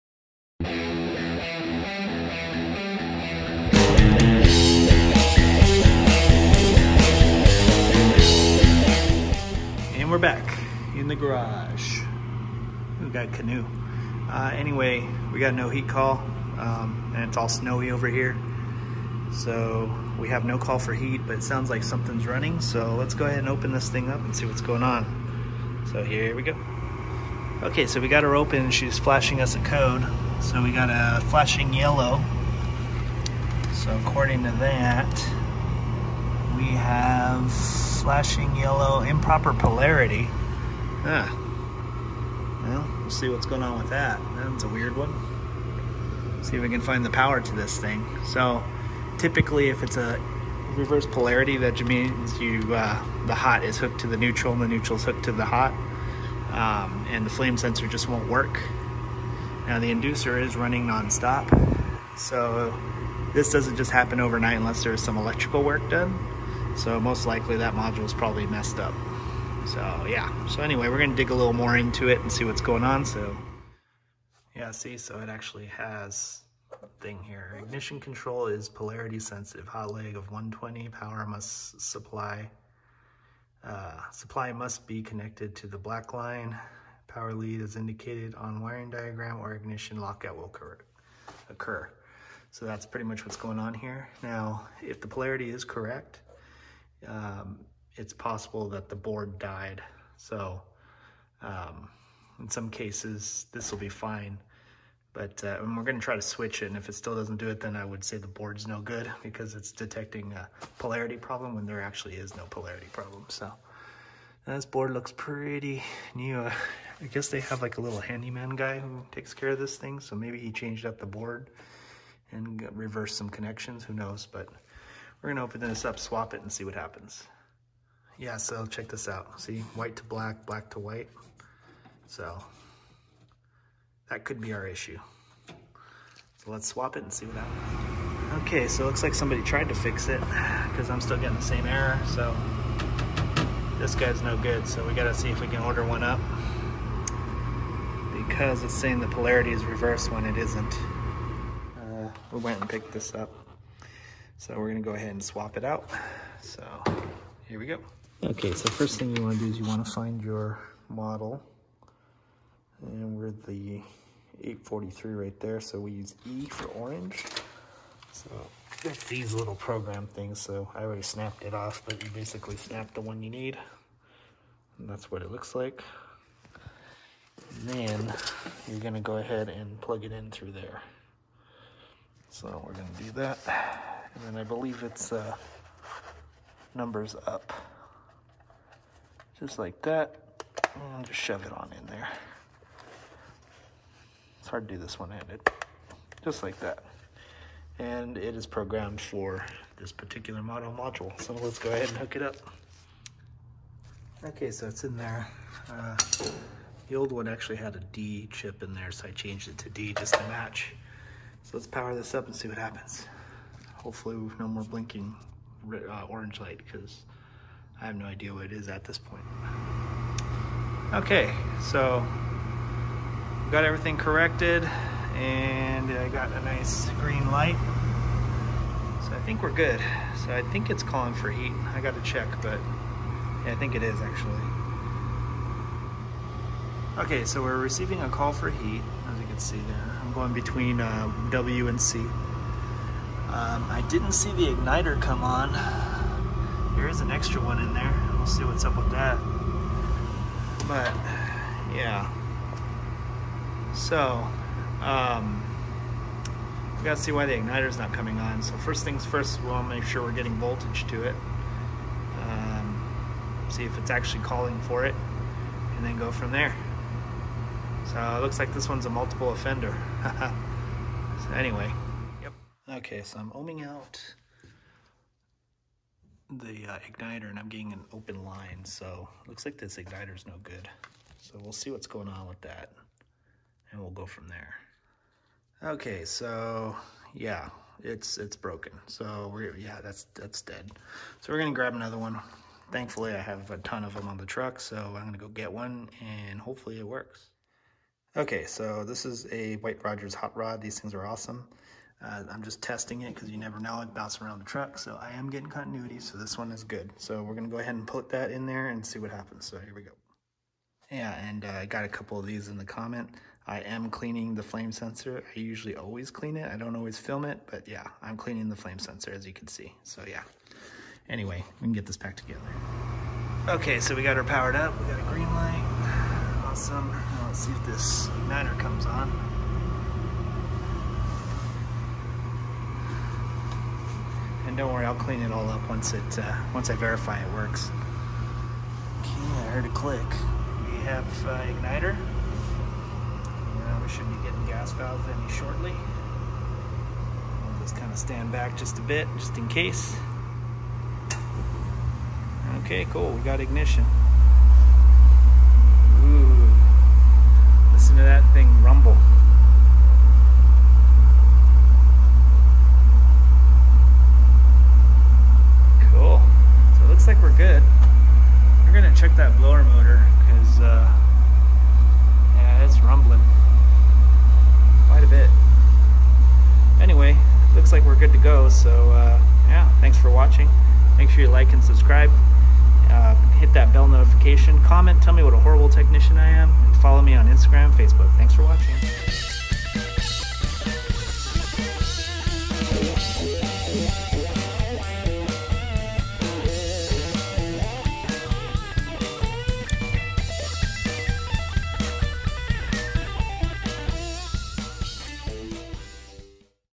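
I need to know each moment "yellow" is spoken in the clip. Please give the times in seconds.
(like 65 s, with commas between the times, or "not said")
31 s, 38 s.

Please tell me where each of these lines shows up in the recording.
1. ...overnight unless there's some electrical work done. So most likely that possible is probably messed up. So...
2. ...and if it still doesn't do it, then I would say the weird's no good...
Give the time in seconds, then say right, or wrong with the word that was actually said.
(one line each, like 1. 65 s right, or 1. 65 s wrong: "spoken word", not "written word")
1. 64 s wrong: "module", not "possible"
2. 106 s wrong: "board", not "weird".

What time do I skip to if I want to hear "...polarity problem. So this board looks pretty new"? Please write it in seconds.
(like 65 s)
112 s.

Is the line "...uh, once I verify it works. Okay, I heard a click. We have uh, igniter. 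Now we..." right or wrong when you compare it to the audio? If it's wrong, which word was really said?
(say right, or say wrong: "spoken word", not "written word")
right.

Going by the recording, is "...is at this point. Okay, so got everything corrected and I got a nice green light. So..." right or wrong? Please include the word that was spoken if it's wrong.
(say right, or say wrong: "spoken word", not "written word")
right.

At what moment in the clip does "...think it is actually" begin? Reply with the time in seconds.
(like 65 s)
233 s.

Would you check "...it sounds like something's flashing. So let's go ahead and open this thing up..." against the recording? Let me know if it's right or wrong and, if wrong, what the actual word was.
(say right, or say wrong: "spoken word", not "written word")
wrong: "running", not "flashing".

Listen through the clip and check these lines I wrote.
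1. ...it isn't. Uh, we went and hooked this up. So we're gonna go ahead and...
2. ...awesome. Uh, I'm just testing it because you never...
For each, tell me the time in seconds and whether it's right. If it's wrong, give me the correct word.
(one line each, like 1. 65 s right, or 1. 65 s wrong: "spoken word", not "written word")
1. 150 s wrong: "picked", not "hooked"
2. 301 s right.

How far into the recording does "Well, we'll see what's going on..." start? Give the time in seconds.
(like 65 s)
42 s.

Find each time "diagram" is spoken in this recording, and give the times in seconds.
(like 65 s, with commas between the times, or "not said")
88 s.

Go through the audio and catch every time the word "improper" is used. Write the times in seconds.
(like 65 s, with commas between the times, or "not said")
39 s.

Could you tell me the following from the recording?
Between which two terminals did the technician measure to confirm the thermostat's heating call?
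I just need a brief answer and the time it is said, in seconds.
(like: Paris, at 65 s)
W and C, at 241 s.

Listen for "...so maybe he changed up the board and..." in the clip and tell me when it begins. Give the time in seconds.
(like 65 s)
119 s.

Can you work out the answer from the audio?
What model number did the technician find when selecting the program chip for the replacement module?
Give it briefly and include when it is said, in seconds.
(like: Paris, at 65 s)
843, at 164 s.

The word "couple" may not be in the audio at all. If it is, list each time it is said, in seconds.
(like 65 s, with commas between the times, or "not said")
311 s.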